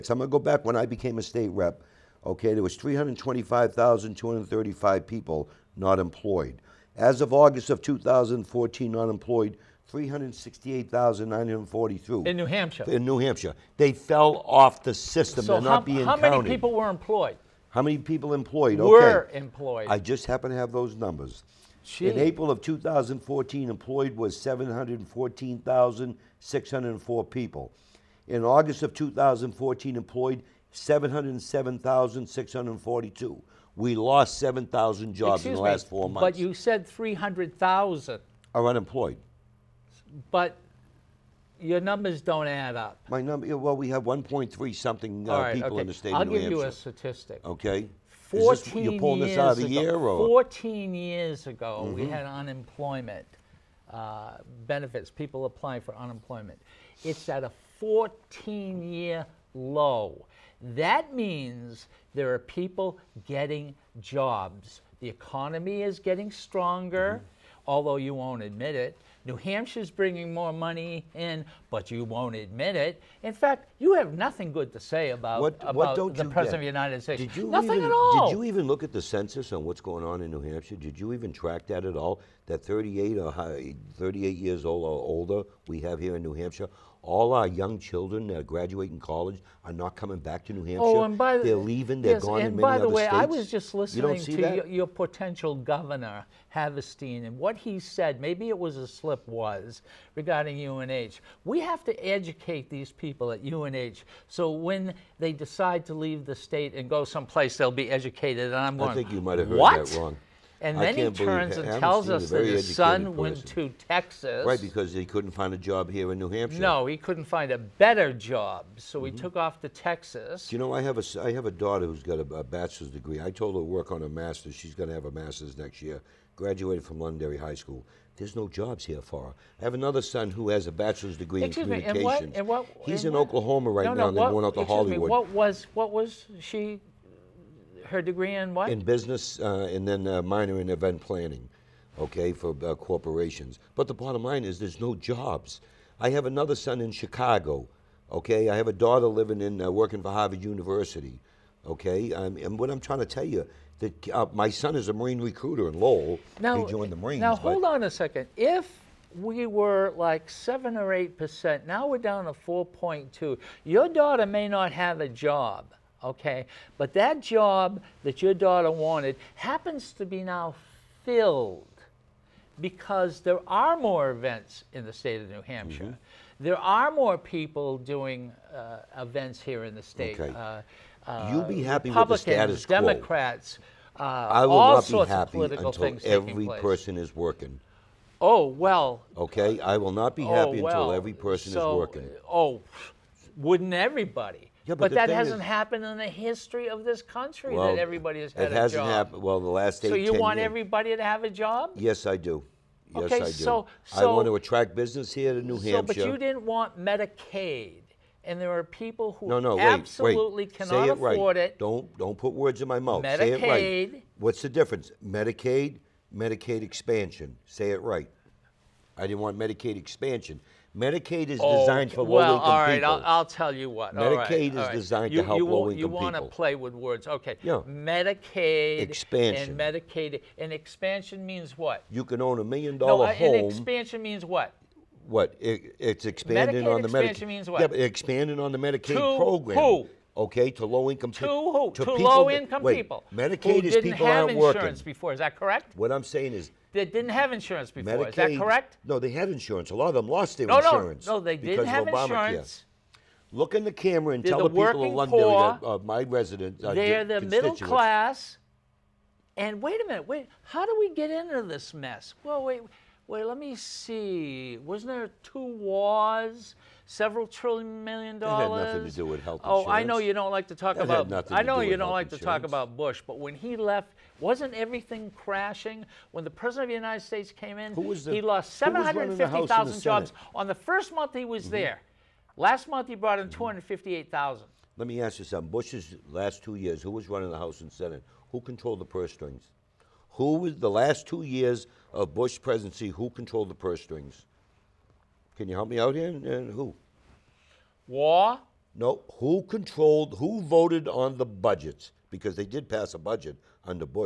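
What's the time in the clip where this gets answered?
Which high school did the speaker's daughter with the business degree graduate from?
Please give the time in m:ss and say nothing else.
2:07.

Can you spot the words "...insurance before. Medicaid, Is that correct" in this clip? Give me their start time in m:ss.
4:07.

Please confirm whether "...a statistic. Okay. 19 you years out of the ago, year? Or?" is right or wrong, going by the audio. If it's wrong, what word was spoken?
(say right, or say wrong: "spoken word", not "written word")
wrong: "14", not "19".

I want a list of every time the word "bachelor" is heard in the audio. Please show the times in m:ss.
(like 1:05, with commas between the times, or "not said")
2:02, 2:10.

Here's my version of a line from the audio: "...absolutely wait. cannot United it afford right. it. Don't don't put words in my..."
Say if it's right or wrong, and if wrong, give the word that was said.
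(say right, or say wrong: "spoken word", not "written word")
wrong: "Say", not "United".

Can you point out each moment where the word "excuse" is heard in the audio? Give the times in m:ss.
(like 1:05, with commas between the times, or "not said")
0:35, 2:11.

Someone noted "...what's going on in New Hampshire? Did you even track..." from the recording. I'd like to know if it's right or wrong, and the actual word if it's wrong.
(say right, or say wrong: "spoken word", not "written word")
right.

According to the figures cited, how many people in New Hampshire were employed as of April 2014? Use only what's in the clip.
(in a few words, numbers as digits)
714,604.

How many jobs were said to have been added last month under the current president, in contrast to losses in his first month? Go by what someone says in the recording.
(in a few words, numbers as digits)
258,000.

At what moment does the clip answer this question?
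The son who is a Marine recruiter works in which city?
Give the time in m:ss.
2:35.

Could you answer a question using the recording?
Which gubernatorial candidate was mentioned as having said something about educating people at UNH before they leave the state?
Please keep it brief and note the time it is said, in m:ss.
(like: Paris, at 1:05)
Havenstein, at 1:36.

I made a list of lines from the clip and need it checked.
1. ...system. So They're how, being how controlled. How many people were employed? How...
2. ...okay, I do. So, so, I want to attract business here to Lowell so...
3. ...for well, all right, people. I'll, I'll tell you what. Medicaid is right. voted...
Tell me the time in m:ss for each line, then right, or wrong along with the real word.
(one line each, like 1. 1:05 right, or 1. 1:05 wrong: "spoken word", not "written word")
1. 0:14 wrong: "counted", not "controlled"
2. 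3:23 wrong: "New", not "Lowell"
3. 3:41 wrong: "designed", not "voted".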